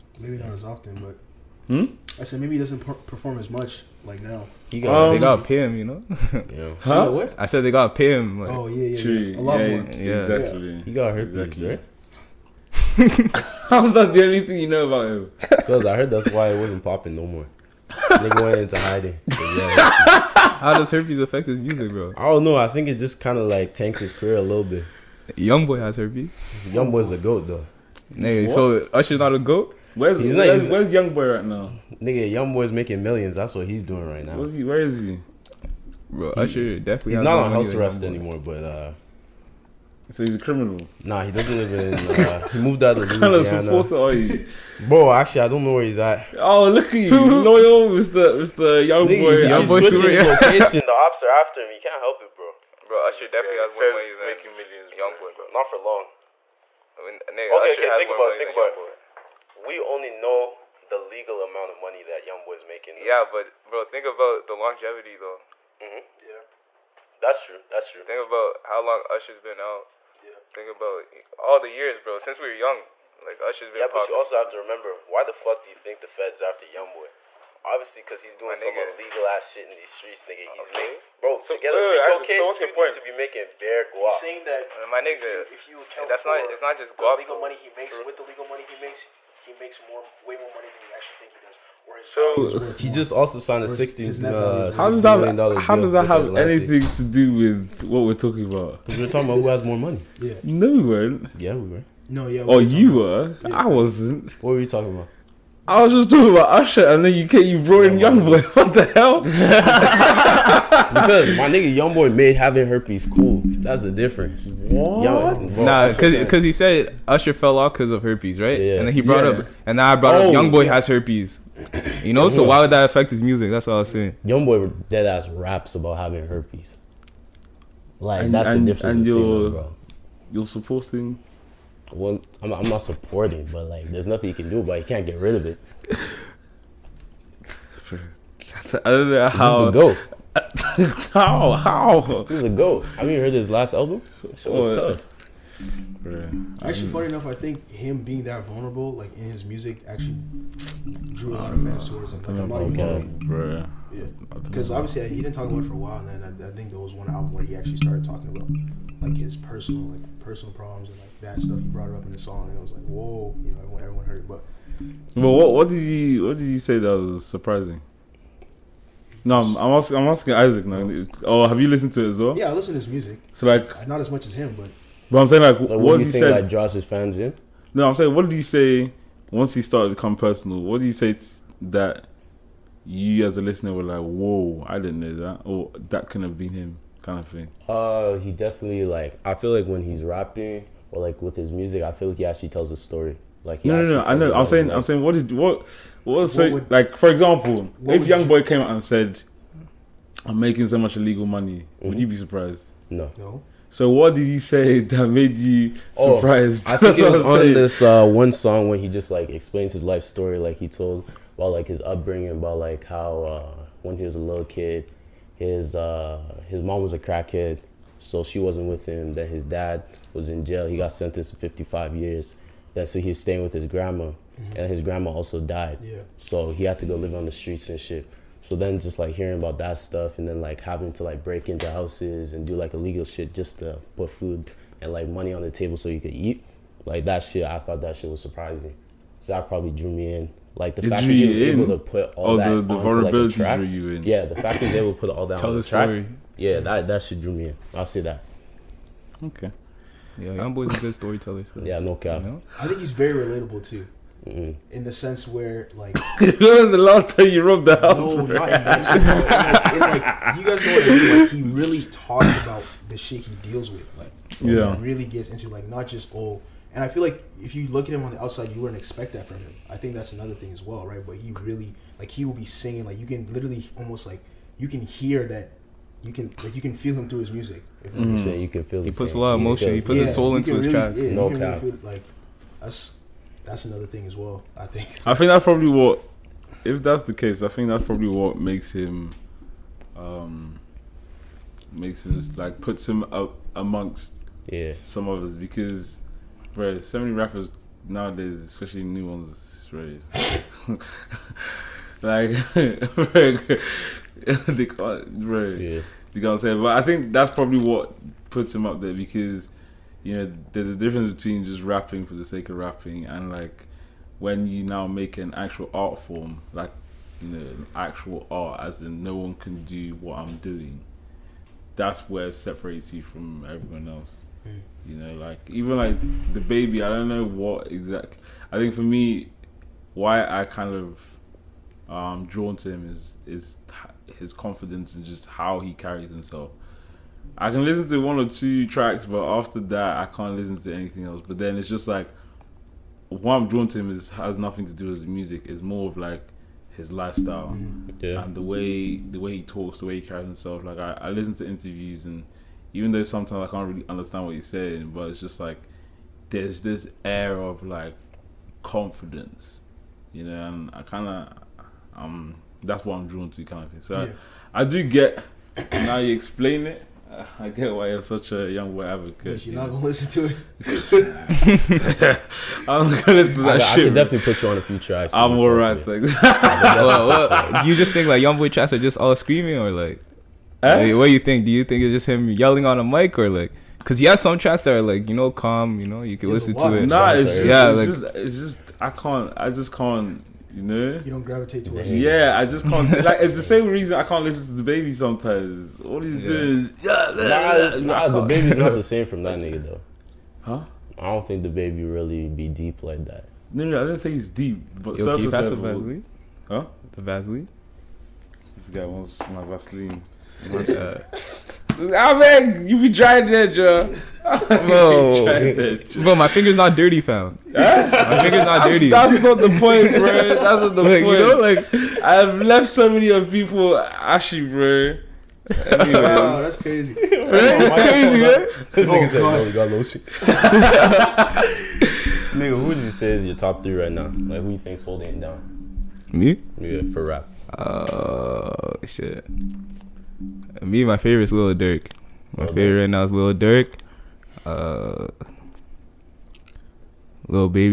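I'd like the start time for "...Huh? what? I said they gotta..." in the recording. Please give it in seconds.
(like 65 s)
6 s.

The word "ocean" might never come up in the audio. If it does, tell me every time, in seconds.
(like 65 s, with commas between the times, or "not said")
not said.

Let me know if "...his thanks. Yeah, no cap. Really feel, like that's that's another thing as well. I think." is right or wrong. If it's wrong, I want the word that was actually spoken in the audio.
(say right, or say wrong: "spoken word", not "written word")
wrong: "tracks", not "thanks".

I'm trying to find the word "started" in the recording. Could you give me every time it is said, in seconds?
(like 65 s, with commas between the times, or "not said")
157 s, 179 s.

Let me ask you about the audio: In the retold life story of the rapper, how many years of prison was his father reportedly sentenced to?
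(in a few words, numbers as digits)
55 years.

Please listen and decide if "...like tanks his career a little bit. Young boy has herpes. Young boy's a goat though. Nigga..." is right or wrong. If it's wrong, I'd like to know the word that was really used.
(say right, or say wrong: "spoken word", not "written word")
right.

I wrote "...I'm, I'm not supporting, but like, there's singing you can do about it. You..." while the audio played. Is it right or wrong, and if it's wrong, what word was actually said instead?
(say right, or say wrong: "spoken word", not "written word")
wrong: "nothing", not "singing".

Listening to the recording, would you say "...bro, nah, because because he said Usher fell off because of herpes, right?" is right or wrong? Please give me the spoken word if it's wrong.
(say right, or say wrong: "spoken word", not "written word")
right.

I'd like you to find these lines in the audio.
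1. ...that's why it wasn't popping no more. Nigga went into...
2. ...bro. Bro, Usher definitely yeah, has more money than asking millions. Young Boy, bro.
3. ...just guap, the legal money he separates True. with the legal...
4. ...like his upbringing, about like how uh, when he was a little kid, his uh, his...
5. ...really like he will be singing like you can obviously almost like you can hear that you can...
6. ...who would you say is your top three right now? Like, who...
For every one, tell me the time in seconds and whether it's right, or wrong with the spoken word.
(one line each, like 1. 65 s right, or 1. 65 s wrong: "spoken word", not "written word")
1. 16 s right
2. 52 s wrong: "making", not "asking"
3. 86 s wrong: "makes", not "separates"
4. 211 s right
5. 271 s wrong: "literally", not "obviously"
6. 432 s right.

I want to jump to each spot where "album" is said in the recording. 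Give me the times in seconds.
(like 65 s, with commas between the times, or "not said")
143 s, 157 s.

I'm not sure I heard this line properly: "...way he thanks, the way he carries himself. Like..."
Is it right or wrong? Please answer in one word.
wrong.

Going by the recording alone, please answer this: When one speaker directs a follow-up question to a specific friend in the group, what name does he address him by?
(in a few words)
Isaac.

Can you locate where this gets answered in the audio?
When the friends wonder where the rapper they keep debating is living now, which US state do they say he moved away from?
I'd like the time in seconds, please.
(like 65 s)
43 s.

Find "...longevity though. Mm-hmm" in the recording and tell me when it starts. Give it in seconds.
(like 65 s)
64 s.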